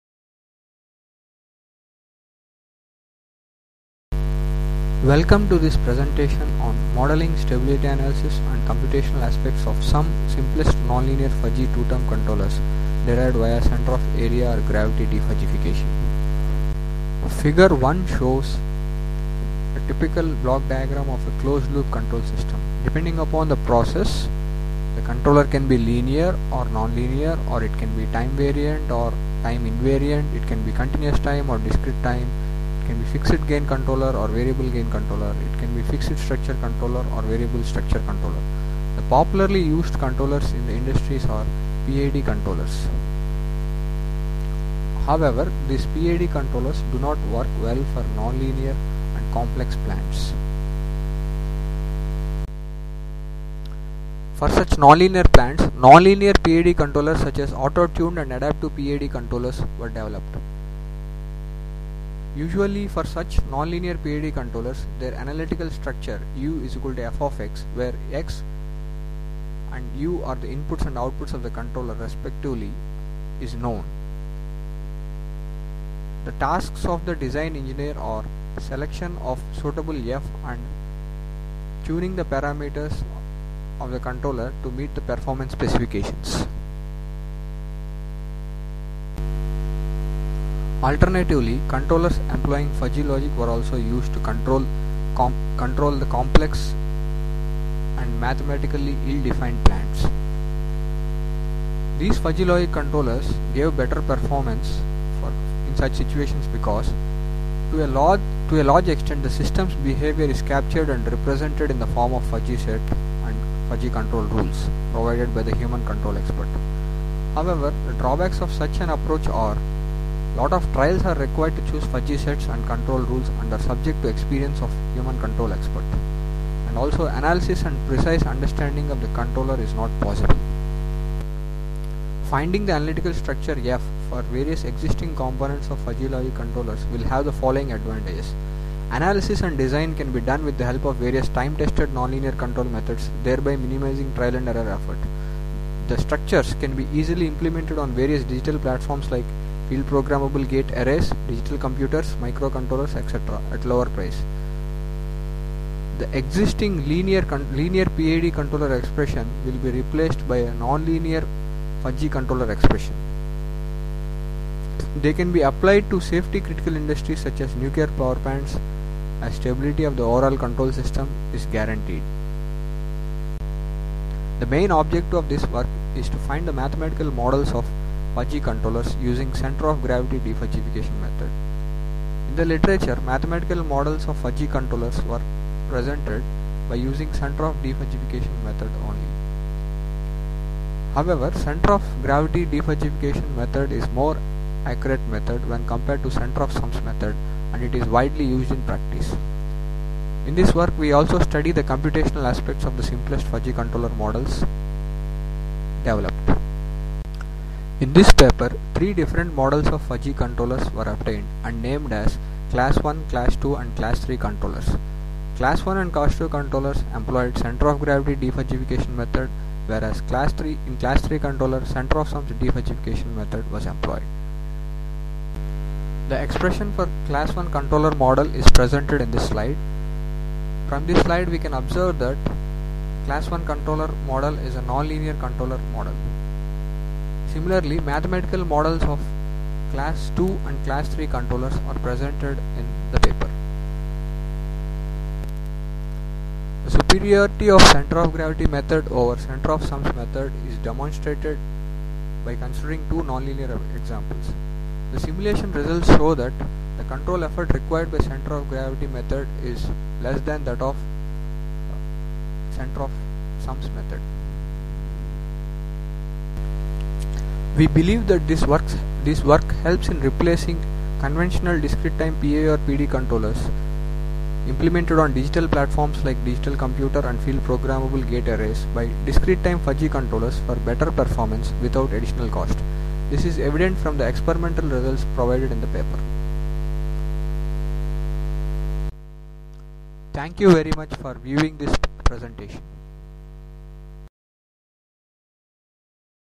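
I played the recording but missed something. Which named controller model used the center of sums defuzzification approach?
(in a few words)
Class 3.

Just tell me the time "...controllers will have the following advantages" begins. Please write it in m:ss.
2:16.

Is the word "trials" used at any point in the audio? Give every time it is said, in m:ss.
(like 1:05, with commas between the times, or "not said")
2:00, 2:24.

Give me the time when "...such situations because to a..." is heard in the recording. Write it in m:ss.
1:45.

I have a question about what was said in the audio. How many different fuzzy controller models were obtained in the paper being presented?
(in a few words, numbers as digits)
3.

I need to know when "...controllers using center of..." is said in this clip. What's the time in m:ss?
2:58.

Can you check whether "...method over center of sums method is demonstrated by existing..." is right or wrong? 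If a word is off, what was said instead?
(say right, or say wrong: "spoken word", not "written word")
wrong: "considering", not "existing".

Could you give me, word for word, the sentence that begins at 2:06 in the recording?
And also analysis and precise understanding of the controller is not possible.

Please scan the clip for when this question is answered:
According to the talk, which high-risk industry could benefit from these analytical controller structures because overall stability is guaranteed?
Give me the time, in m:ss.
2:47.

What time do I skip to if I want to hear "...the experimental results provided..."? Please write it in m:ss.
4:43.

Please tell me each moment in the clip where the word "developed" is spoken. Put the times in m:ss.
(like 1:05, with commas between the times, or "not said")
0:59, 3:25.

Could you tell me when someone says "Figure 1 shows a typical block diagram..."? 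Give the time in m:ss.
0:17.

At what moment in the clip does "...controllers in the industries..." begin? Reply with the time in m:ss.
0:40.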